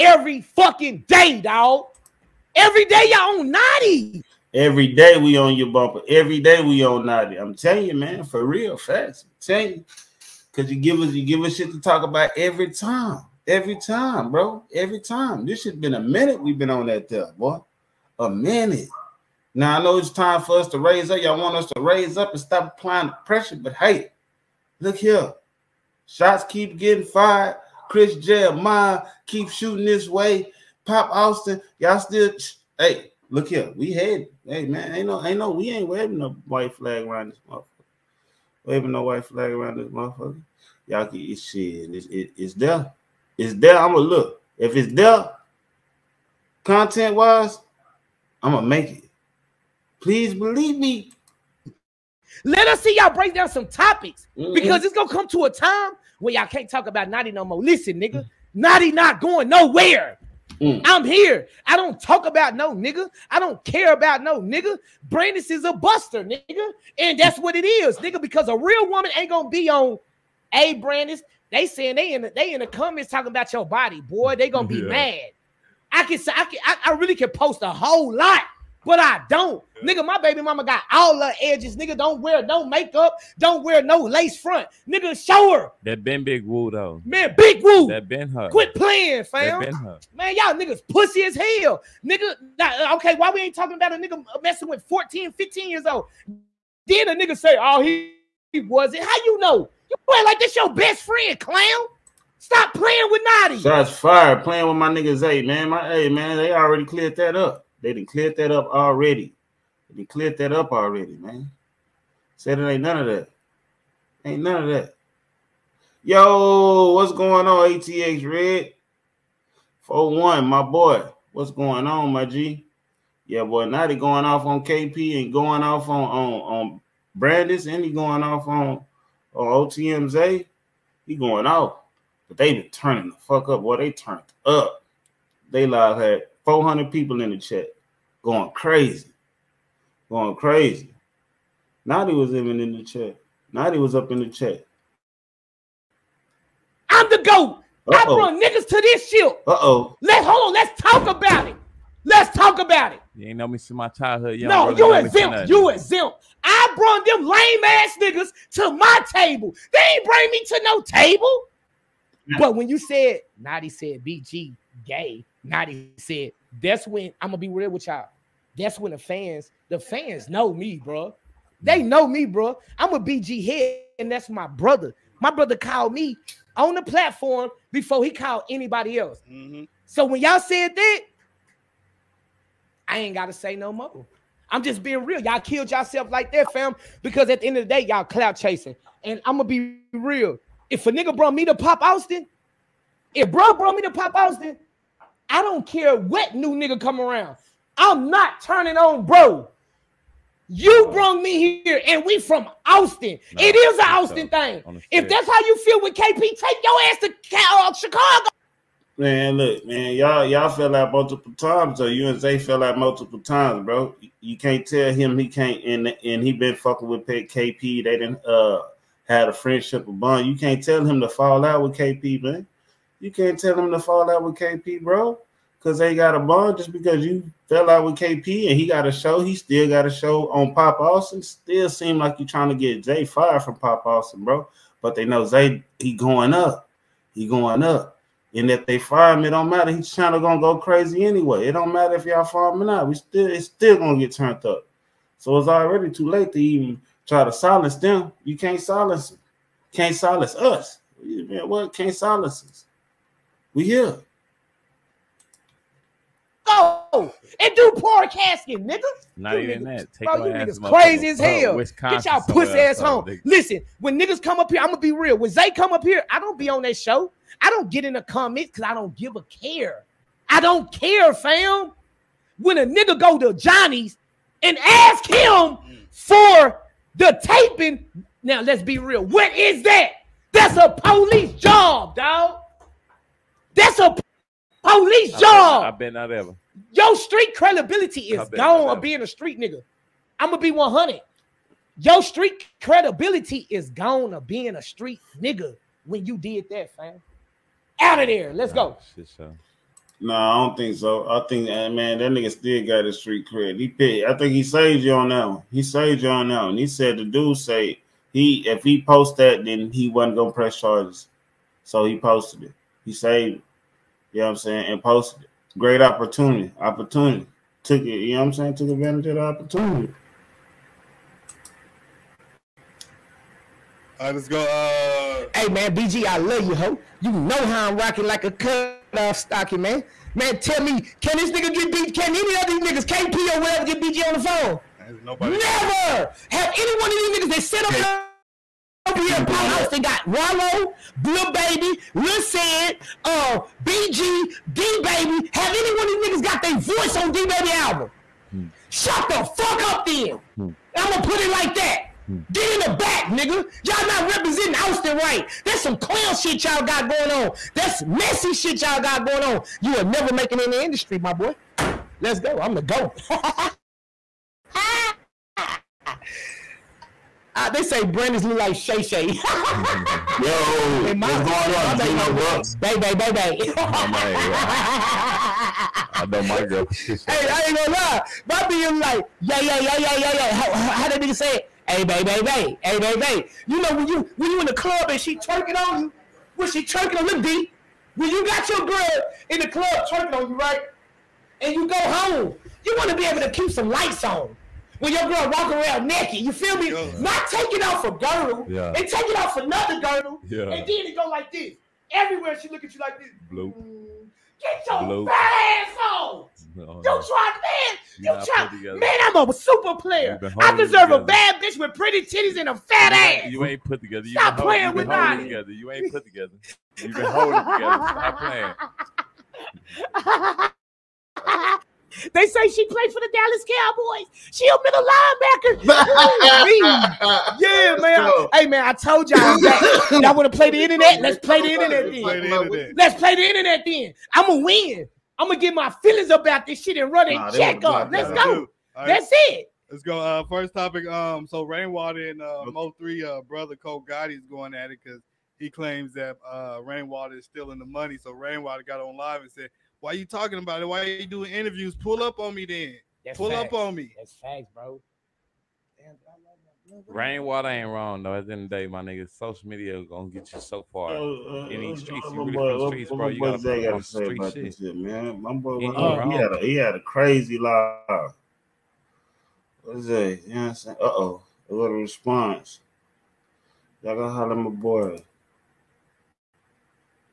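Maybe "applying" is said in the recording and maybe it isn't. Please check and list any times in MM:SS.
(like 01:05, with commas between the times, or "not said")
00:22.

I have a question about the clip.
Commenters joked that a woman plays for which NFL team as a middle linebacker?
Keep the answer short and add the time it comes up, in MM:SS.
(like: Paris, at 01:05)
Dallas Cowboys, at 07:03.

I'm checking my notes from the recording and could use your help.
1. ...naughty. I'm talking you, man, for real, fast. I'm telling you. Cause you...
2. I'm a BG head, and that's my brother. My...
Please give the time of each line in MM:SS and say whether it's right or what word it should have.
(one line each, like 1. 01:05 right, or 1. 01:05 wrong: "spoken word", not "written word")
1. 00:07 wrong: "telling", not "talking"
2. 02:52 right.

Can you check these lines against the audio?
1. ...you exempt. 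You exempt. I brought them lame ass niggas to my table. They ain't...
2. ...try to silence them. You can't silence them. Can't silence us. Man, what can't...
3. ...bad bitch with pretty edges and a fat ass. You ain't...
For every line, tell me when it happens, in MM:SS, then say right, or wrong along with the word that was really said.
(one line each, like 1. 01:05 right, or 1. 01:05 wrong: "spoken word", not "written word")
1. 02:34 right
2. 04:07 right
3. 06:51 wrong: "titties", not "edges".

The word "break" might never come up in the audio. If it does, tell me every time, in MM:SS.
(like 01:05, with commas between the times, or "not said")
00:53.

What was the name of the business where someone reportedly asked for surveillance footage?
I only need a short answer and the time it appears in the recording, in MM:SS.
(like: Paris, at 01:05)
Johnny's, at 04:33.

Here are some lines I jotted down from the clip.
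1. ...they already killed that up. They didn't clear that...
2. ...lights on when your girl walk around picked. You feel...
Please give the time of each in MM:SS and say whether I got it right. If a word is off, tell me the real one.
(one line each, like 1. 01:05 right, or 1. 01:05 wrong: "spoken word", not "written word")
1. 01:46 wrong: "cleared", not "killed"
2. 06:33 wrong: "naked", not "picked".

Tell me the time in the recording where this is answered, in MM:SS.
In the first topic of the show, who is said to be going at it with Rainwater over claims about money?
07:23.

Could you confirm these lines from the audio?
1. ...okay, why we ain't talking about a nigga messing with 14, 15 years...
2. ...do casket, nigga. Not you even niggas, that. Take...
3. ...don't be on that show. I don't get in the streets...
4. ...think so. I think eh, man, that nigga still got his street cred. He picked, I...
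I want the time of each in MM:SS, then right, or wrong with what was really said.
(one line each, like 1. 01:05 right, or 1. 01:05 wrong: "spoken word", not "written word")
1. 01:32 right
2. 04:17 right
3. 04:26 wrong: "comments", not "streets"
4. 05:00 right.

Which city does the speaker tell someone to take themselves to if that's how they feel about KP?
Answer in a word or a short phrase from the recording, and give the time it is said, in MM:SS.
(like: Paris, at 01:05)
Chicago, at 03:27.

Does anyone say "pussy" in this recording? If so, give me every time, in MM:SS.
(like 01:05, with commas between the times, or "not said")
01:30, 04:22.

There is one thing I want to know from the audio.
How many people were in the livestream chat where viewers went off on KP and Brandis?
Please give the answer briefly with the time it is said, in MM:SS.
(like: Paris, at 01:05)
400, at 02:16.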